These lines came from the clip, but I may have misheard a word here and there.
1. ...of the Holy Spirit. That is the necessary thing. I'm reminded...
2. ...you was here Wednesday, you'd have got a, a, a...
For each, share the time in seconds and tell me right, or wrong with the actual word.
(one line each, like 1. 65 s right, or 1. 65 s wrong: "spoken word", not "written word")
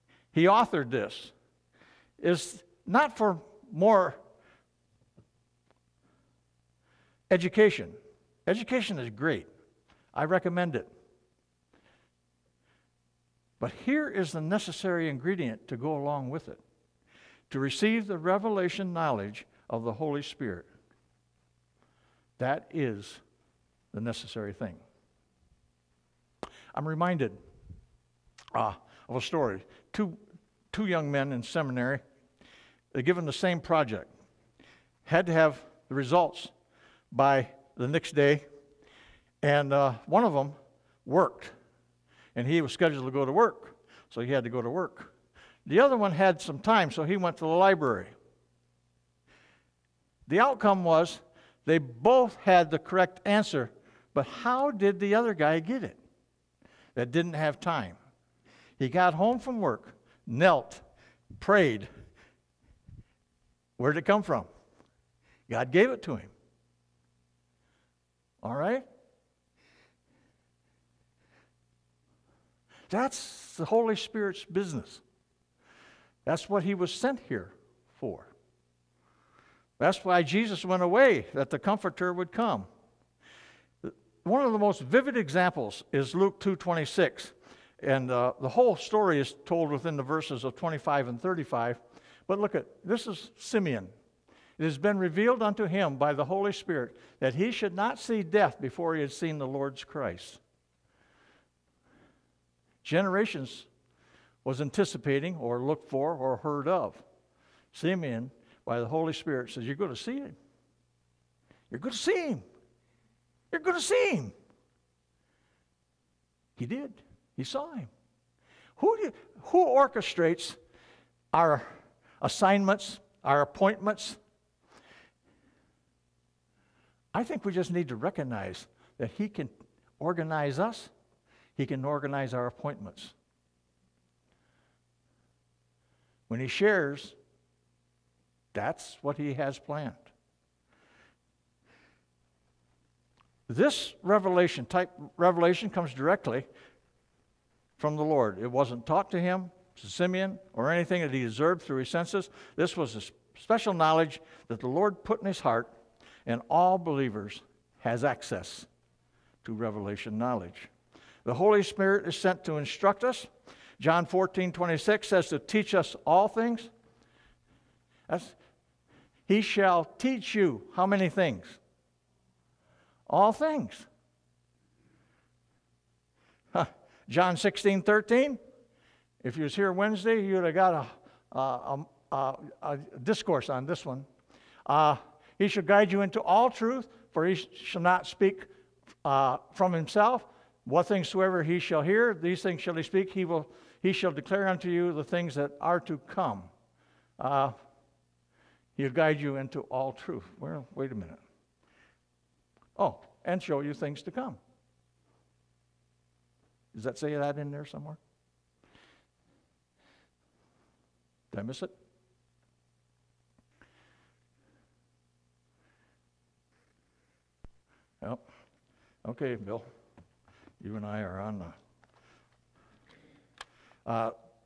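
1. 19 s right
2. 179 s right.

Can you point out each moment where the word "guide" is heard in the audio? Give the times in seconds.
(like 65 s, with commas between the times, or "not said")
185 s, 198 s.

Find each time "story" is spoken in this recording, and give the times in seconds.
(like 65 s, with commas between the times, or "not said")
29 s, 88 s.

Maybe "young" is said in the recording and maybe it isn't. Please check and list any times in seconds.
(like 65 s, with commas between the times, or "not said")
30 s.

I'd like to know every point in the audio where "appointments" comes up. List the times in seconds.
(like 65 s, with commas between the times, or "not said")
123 s, 132 s.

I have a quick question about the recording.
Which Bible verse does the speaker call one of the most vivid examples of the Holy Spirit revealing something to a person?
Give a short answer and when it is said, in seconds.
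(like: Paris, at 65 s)
Luke 2:26, at 86 s.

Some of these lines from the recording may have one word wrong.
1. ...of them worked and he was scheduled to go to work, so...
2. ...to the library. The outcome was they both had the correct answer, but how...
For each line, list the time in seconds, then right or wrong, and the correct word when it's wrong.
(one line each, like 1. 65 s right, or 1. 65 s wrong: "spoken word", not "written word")
1. 40 s right
2. 47 s right.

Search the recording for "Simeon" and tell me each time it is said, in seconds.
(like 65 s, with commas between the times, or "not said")
93 s, 107 s, 149 s.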